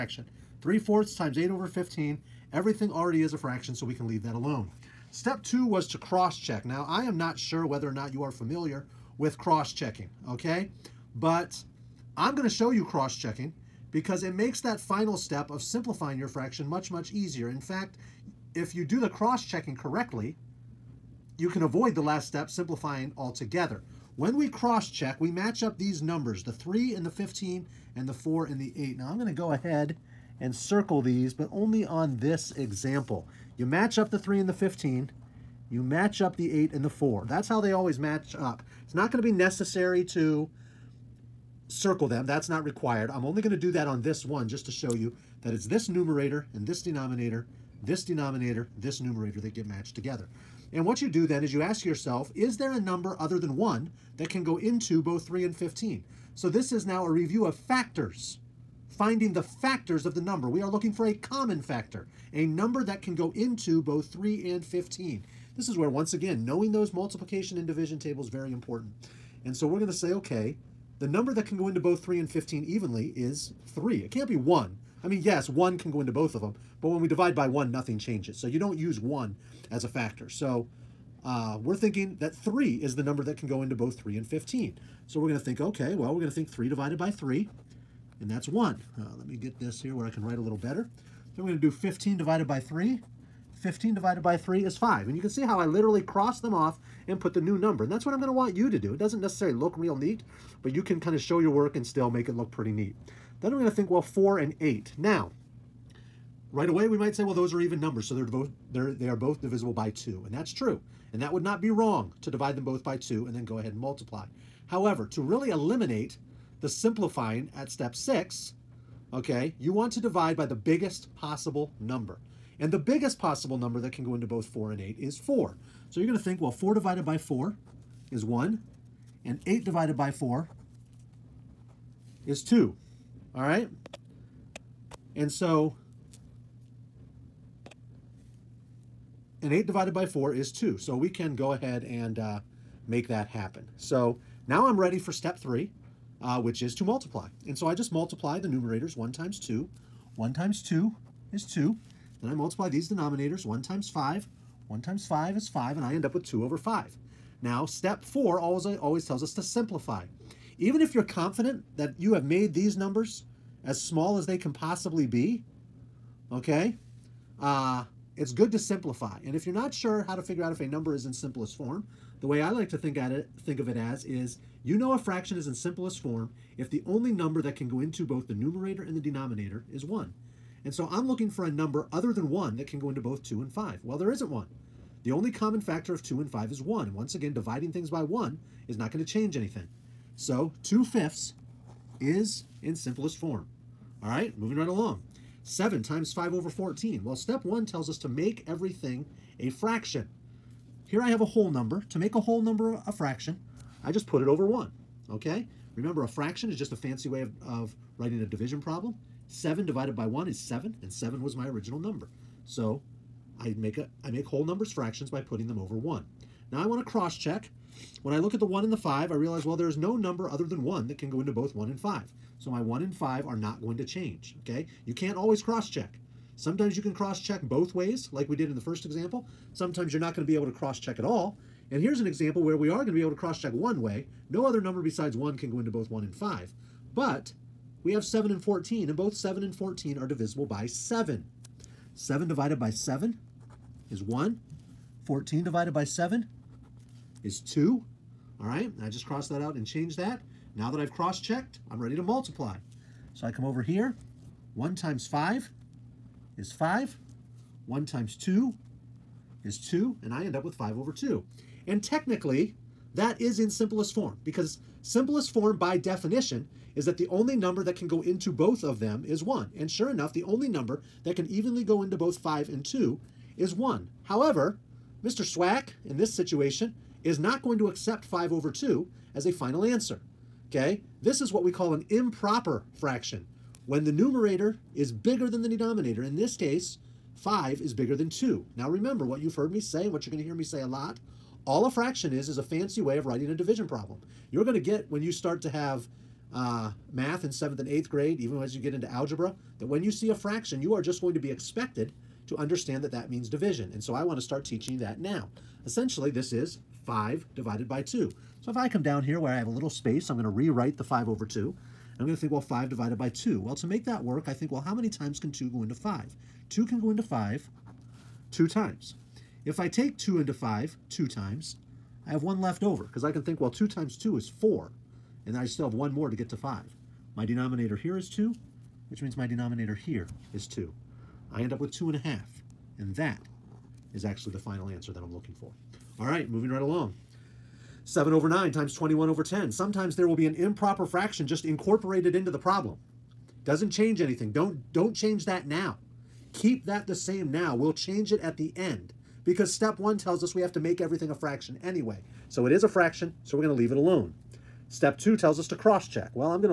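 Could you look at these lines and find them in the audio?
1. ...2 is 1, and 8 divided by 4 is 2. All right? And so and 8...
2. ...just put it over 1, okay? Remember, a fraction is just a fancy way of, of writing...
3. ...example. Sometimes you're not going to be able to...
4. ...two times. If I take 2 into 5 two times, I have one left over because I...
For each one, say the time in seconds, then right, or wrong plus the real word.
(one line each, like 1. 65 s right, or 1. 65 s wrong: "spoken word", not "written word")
1. 127 s wrong: "4", not "2"
2. 203 s right
3. 228 s right
4. 318 s right.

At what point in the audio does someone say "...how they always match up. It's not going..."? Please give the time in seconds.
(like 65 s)
37 s.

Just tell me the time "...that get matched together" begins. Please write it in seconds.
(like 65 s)
49 s.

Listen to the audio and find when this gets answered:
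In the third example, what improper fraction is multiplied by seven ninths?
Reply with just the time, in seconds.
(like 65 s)
338 s.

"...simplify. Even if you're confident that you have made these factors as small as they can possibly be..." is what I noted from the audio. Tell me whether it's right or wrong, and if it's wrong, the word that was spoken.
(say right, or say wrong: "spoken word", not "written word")
wrong: "numbers", not "factors".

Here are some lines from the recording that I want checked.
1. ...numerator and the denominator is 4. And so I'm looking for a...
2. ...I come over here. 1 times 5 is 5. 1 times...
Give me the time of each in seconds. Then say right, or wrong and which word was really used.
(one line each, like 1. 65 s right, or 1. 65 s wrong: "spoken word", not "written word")
1. 178 s wrong: "1", not "4"
2. 253 s right.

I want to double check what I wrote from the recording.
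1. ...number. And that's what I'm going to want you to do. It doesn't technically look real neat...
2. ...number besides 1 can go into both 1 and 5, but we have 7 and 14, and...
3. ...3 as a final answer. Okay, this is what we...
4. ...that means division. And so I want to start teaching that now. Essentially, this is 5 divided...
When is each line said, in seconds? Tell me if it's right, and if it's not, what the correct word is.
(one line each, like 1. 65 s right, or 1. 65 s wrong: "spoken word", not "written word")
1. 97 s wrong: "necessarily", not "technically"
2. 234 s right
3. 278 s wrong: "2", not "3"
4. 302 s right.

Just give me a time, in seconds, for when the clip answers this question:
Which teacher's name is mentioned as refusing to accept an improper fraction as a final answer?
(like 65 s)
275 s.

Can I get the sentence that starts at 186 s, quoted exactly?
And once again, dividing things by 1 is not going to change anything.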